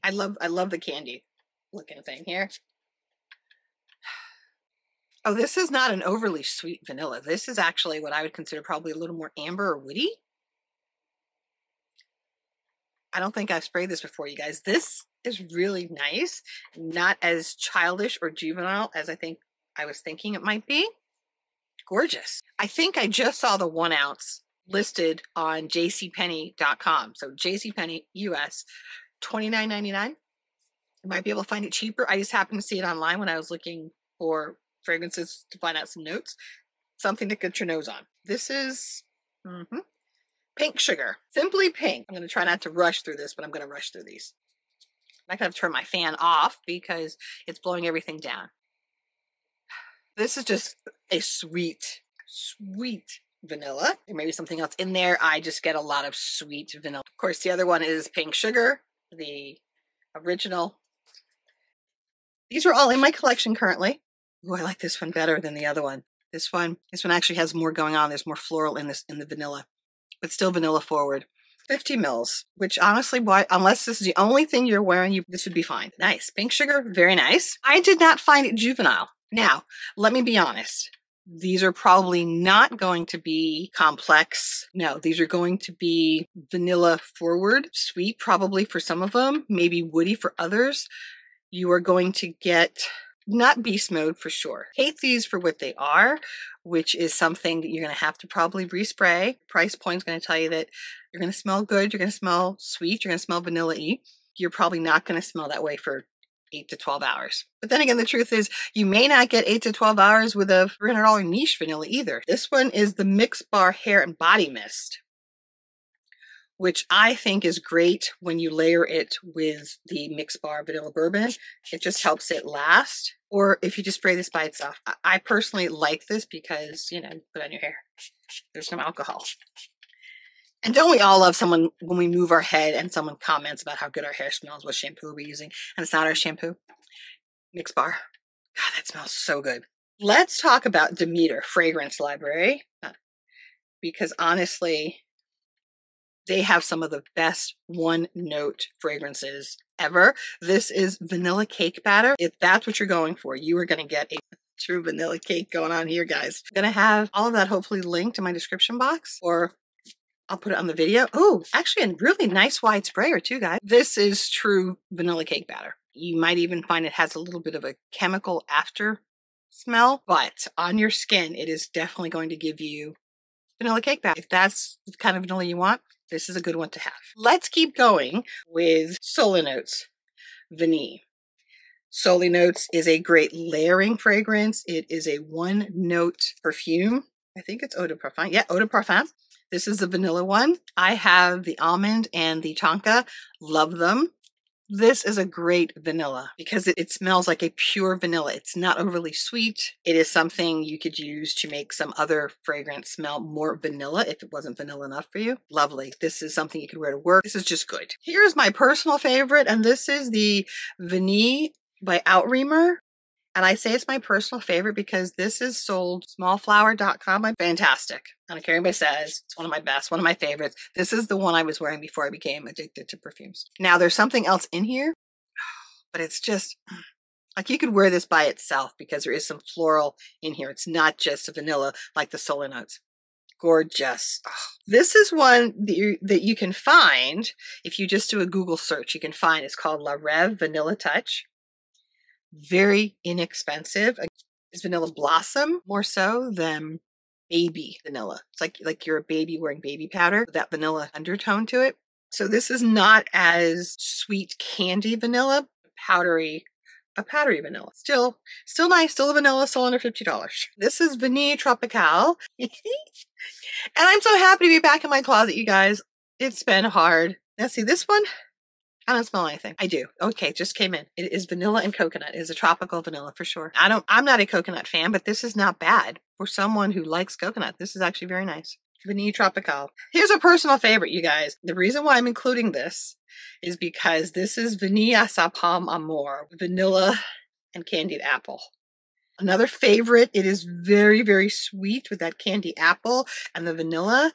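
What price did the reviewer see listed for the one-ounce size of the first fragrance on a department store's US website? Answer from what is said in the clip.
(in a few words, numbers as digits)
$29.99.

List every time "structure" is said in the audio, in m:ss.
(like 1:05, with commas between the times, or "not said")
not said.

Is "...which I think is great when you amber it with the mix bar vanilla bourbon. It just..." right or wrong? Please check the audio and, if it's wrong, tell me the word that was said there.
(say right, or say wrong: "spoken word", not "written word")
wrong: "layer", not "amber".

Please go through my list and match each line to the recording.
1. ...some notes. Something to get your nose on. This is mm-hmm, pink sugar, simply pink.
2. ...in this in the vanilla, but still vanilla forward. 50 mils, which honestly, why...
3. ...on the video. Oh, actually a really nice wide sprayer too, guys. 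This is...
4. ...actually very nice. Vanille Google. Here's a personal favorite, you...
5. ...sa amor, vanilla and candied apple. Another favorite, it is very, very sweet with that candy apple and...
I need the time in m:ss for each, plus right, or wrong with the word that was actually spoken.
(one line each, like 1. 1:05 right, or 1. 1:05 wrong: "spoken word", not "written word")
1. 0:35 right
2. 1:08 right
3. 2:40 right
4. 4:37 wrong: "Tropical", not "Google"
5. 4:45 right.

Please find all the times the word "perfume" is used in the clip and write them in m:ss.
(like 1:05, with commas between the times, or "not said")
3:06, 3:42.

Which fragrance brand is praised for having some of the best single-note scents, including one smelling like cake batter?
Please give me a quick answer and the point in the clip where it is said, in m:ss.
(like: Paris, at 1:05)
Demeter Fragrance Library, at 2:20.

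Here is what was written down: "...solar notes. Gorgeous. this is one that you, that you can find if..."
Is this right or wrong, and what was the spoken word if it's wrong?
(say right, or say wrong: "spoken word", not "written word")
right.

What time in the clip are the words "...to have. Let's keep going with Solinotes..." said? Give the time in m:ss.
2:56.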